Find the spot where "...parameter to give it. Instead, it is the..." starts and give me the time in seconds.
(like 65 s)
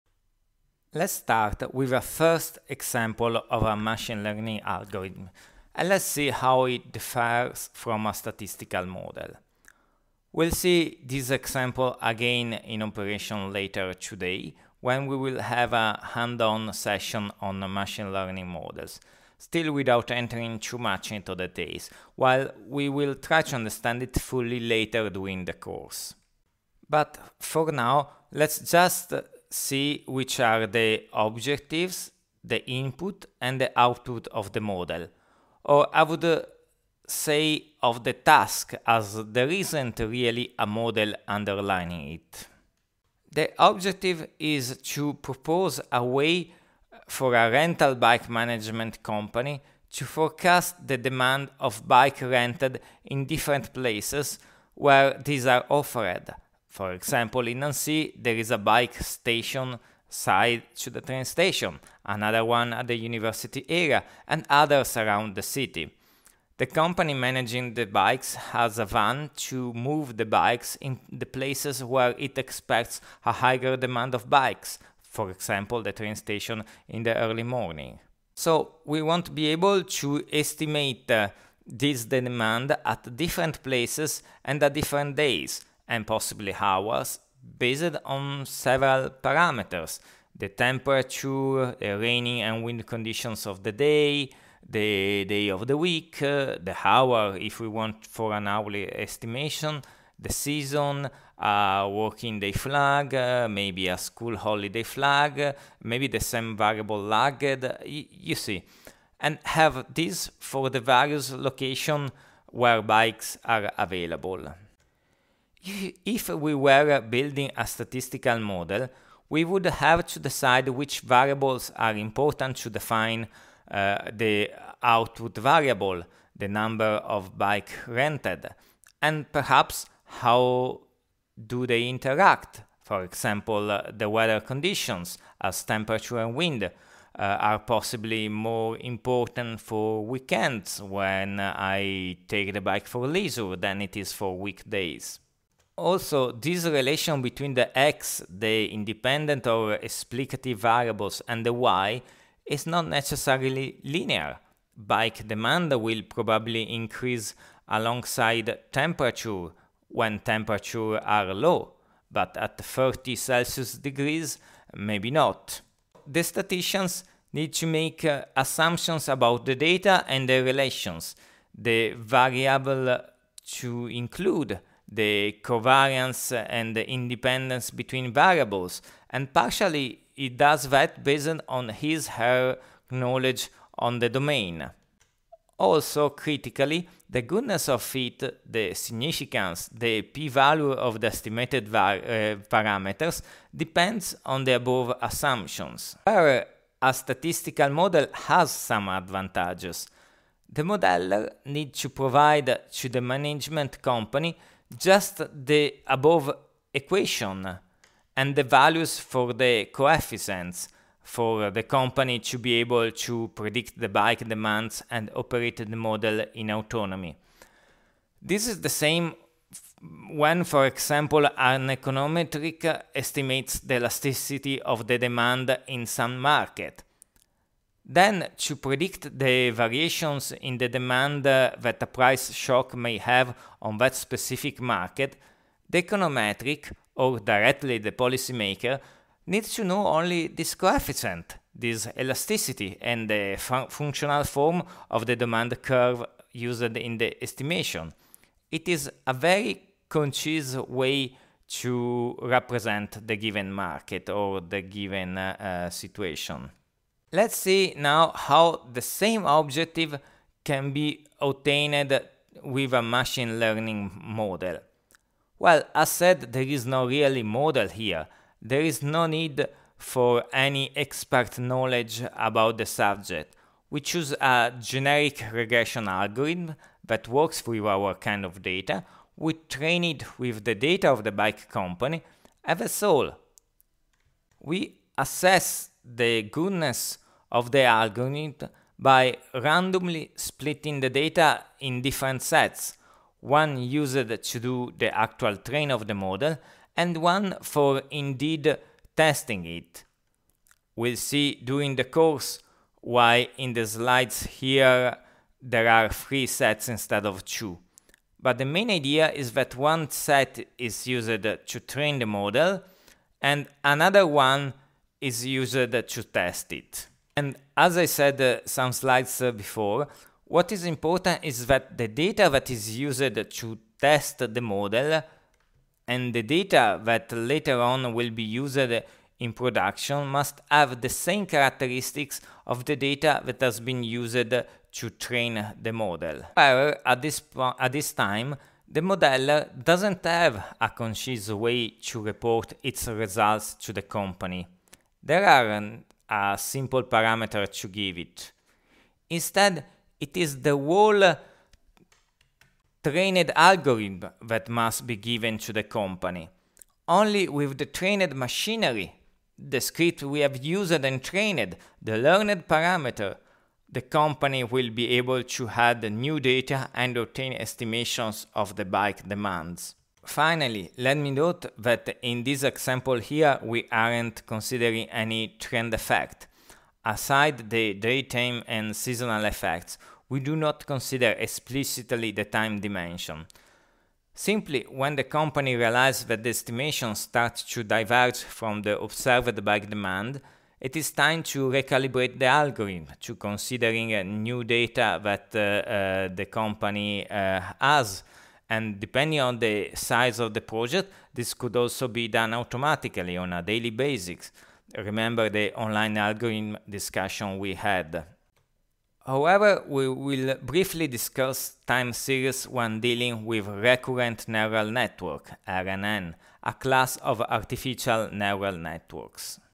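346 s.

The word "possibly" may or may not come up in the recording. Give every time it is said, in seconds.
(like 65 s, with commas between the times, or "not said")
86 s, 137 s.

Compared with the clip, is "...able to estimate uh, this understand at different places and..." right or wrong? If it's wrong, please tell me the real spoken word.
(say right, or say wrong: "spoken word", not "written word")
wrong: "demand", not "understand".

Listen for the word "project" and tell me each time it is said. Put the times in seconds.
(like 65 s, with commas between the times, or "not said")
400 s.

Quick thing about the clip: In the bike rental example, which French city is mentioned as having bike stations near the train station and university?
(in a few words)
Nancy.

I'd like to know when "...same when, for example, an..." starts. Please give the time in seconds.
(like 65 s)
218 s.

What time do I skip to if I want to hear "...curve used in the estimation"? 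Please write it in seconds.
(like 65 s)
245 s.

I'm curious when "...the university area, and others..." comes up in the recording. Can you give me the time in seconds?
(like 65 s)
62 s.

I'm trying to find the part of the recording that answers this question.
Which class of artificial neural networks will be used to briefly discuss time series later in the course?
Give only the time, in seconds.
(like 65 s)
413 s.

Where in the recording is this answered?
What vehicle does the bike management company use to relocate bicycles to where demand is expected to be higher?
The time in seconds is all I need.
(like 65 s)
68 s.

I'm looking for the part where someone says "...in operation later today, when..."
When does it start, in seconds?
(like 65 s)
12 s.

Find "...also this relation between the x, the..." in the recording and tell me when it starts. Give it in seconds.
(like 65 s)
145 s.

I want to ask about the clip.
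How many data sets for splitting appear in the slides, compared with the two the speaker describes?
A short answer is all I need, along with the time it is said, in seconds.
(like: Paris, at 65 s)
3, at 305 s.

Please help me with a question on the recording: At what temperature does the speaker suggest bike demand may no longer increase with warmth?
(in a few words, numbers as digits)
30 Celsius degrees.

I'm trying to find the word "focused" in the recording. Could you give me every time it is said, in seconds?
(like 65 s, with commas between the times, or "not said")
not said.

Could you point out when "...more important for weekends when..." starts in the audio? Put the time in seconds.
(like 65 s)
138 s.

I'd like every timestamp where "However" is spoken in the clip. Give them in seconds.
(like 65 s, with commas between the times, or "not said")
196 s, 336 s, 409 s.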